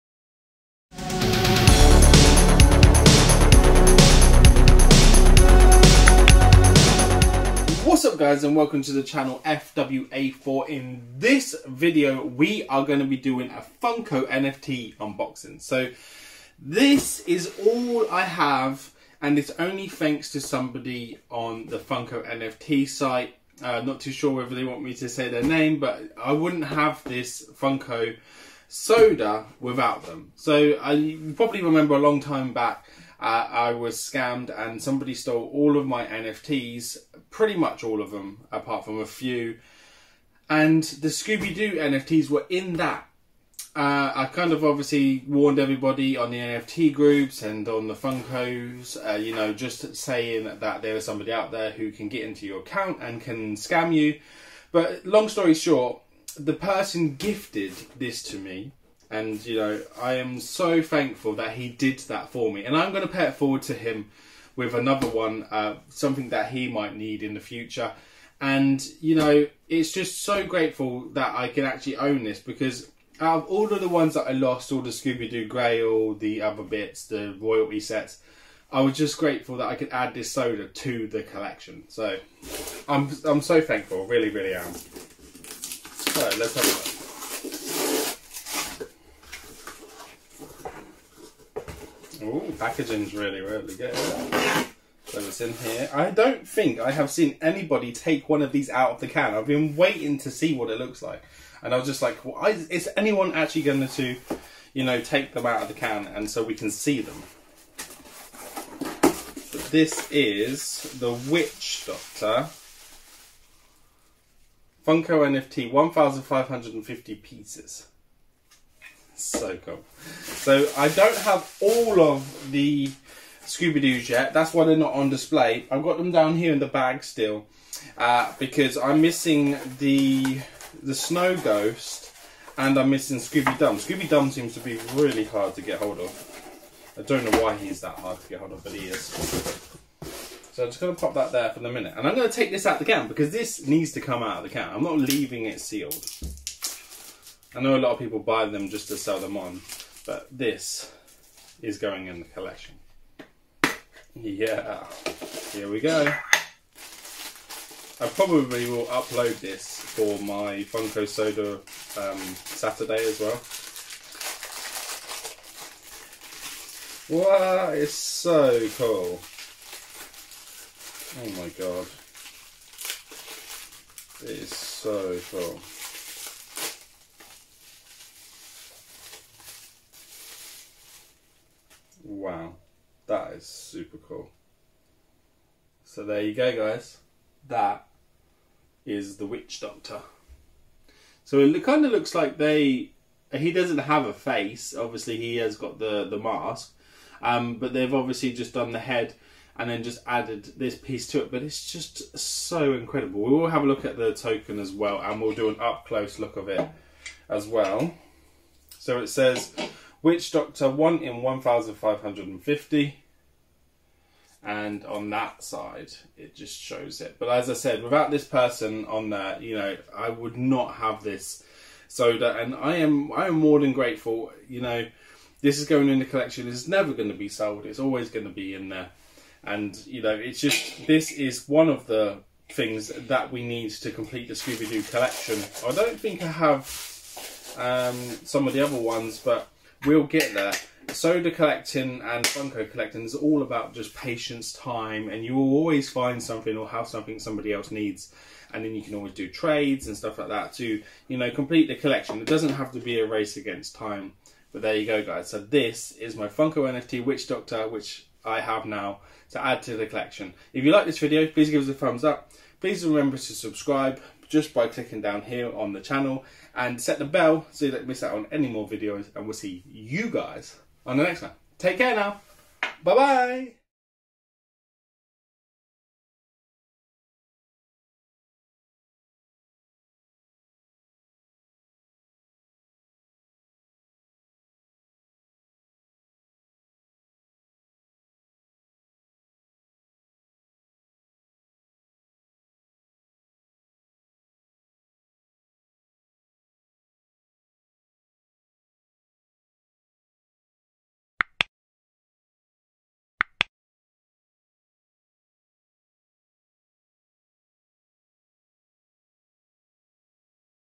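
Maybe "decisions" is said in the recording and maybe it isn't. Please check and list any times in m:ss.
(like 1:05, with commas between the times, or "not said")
not said.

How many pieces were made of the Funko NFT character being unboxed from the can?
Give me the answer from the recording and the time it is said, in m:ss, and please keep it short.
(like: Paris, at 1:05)
1550, at 1:55.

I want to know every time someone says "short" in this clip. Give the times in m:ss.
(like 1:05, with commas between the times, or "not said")
0:55.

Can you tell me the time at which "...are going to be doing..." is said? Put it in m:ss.
0:12.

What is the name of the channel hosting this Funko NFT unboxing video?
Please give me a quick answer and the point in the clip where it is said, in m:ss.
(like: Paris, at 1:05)
FWA4, at 0:09.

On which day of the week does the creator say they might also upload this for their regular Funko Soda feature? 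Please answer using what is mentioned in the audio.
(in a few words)
Saturday.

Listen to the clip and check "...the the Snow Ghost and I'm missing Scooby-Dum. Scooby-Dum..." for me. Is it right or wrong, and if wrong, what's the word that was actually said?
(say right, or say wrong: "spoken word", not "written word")
right.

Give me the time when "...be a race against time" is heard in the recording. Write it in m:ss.
4:12.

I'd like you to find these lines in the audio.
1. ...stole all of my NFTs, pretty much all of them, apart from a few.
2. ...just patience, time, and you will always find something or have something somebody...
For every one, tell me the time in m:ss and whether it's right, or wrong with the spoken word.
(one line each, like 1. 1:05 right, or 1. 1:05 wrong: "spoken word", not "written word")
1. 0:35 right
2. 4:03 right.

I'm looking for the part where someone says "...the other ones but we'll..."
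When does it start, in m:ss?
3:58.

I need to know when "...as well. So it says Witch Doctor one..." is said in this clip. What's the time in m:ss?
3:27.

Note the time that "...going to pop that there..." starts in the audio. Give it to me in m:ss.
2:20.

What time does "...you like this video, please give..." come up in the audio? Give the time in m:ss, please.
4:20.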